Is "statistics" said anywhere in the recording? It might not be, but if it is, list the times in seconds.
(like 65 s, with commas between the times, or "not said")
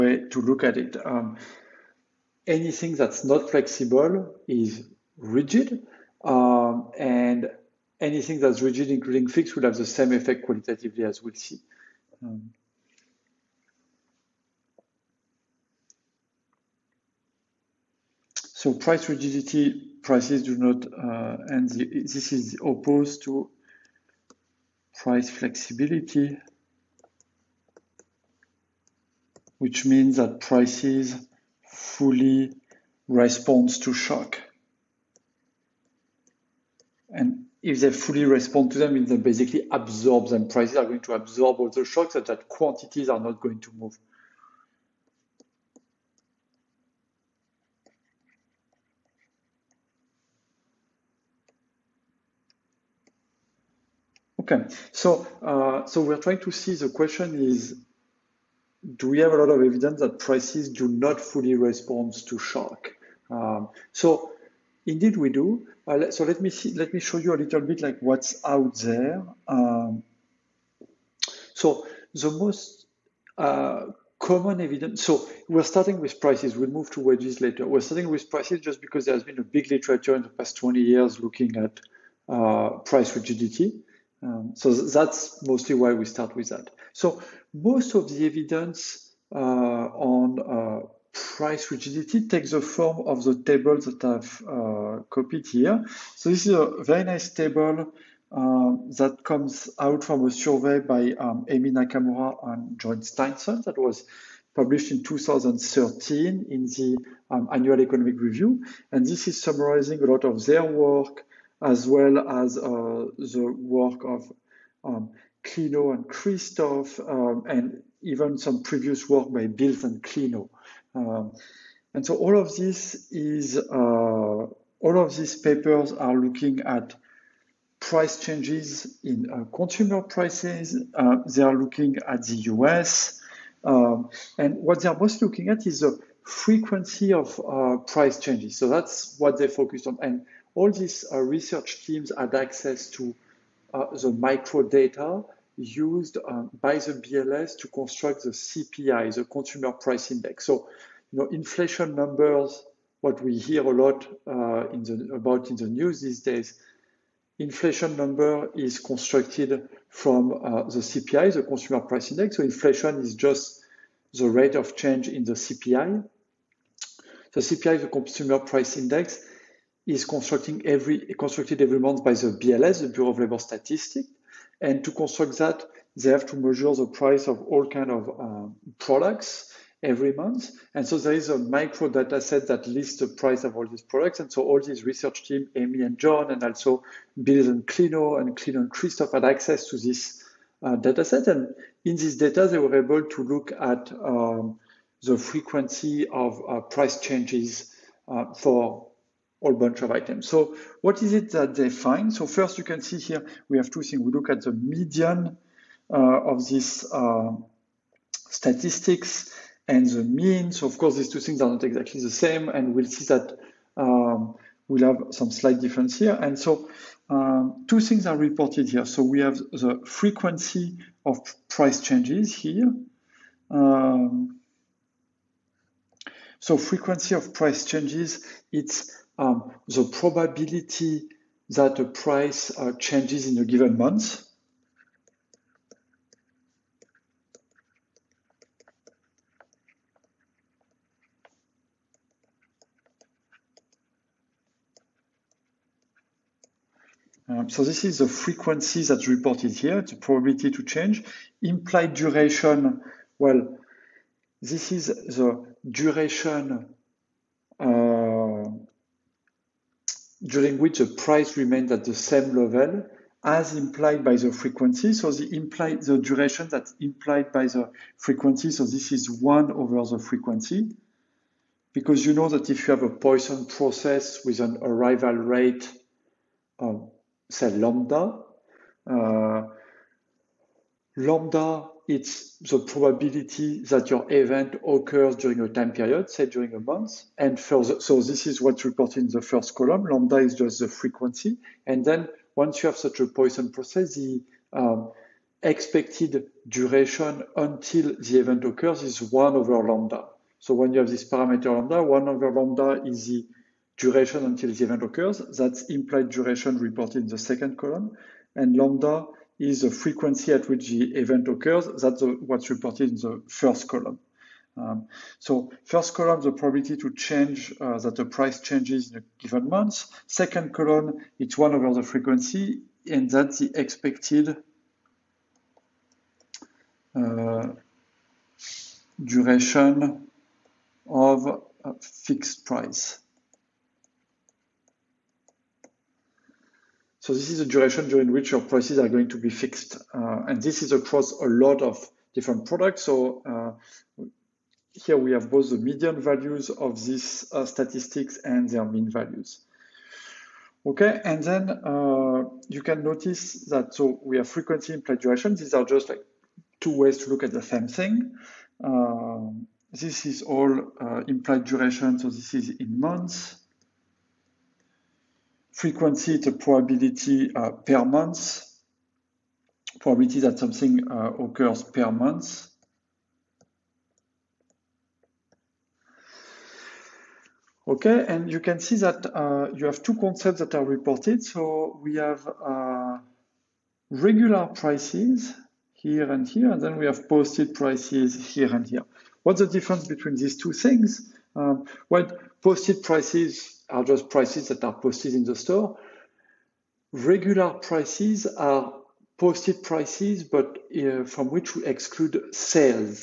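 173 s, 208 s, 347 s.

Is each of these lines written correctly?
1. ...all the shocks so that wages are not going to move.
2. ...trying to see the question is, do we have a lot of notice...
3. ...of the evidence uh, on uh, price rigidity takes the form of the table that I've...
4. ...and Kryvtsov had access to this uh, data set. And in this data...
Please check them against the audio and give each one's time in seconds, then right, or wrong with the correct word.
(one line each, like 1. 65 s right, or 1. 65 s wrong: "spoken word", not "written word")
1. 41 s wrong: "quantities", not "wages"
2. 56 s wrong: "evidence", not "notice"
3. 87 s right
4. 188 s right.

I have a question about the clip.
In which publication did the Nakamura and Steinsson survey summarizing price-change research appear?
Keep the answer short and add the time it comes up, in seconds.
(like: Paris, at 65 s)
Annual Economic Review, at 107 s.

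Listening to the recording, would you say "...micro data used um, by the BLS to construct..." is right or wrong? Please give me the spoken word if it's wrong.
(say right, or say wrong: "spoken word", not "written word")
right.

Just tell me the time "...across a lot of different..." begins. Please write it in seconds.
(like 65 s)
340 s.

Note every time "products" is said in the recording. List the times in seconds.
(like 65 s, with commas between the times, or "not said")
178 s, 183 s, 342 s.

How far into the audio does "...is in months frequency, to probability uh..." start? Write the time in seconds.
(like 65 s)
362 s.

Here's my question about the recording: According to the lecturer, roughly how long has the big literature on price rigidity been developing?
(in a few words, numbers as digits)
past 20 years.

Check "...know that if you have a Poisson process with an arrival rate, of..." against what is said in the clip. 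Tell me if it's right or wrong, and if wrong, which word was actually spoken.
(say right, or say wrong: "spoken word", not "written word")
right.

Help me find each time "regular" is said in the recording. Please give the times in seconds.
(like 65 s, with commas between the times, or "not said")
383 s, 396 s.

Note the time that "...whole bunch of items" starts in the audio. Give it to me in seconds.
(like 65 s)
199 s.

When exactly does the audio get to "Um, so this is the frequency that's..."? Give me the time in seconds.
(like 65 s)
247 s.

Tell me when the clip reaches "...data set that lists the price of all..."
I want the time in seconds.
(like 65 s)
181 s.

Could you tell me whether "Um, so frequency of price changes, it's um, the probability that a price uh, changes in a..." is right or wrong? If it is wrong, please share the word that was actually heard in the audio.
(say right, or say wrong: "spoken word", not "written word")
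right.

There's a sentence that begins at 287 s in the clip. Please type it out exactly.
And further, so this is what's reported in the first column.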